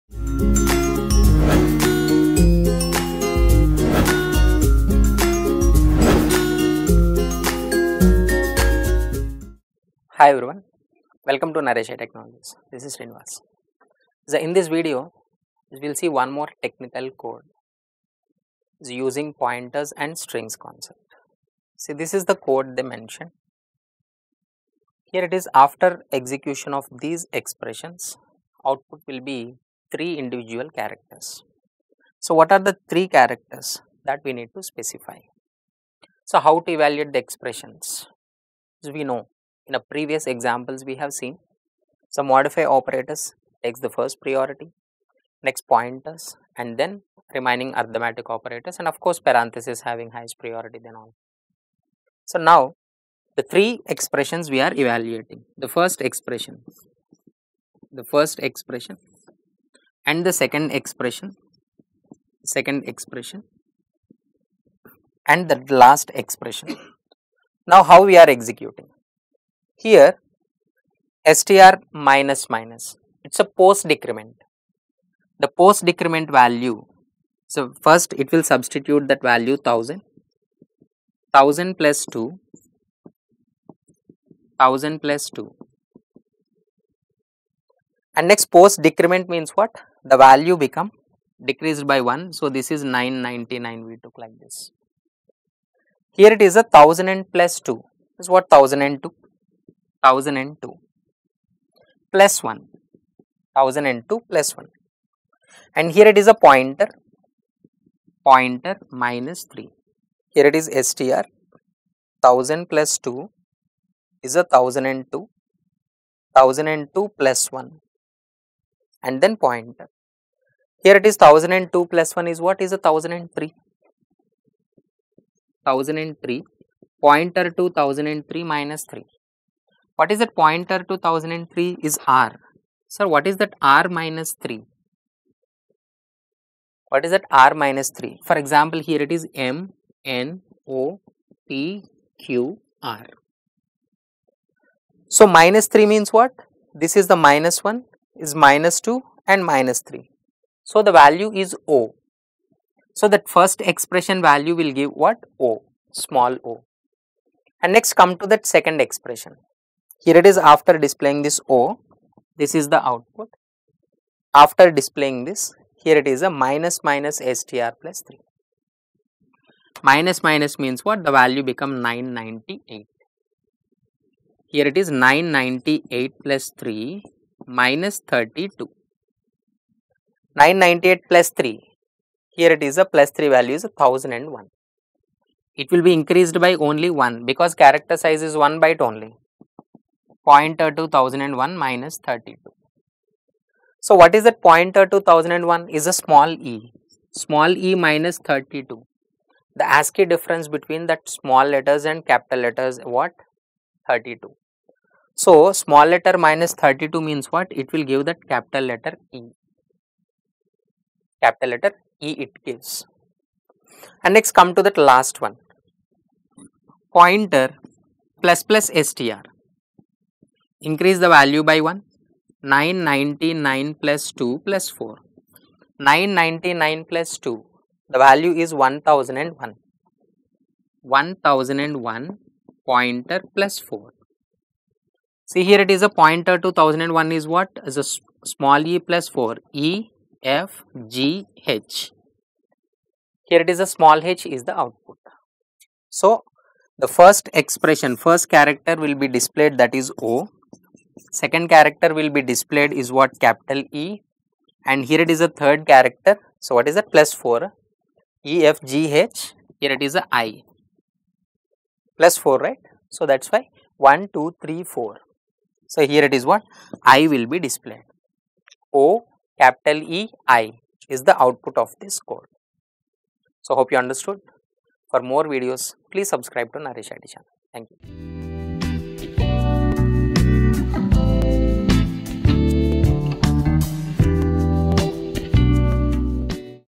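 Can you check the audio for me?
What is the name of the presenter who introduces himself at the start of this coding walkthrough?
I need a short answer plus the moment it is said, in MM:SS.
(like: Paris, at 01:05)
Srinivas, at 00:12.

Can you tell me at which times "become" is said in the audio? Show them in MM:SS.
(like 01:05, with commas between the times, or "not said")
01:30, 02:51.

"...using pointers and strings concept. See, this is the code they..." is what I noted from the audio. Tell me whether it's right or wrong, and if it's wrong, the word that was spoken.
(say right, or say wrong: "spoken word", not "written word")
right.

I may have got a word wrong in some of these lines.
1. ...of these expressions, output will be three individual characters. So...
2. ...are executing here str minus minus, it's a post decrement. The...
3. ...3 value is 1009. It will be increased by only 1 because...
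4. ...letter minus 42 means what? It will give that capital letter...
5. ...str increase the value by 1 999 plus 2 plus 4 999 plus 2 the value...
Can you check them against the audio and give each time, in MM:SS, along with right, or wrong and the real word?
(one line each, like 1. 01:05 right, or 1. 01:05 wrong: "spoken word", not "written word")
1. 00:26 right
2. 01:08 right
3. 03:03 wrong: "1001", not "1009"
4. 03:25 wrong: "32", not "42"
5. 03:38 right.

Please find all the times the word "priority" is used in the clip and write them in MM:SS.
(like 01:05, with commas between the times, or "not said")
00:44, 00:50.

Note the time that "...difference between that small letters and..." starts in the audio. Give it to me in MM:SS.
03:20.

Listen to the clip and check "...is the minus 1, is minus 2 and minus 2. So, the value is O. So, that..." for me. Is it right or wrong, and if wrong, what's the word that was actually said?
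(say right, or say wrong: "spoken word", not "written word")
wrong: "3", not "2".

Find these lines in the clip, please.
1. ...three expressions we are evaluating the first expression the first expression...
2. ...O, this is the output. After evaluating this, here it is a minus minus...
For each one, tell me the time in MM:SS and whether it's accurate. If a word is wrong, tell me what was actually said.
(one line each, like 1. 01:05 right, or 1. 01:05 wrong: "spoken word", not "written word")
1. 00:53 right
2. 02:41 wrong: "displaying", not "evaluating".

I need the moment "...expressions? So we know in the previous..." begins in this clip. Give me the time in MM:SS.
00:37.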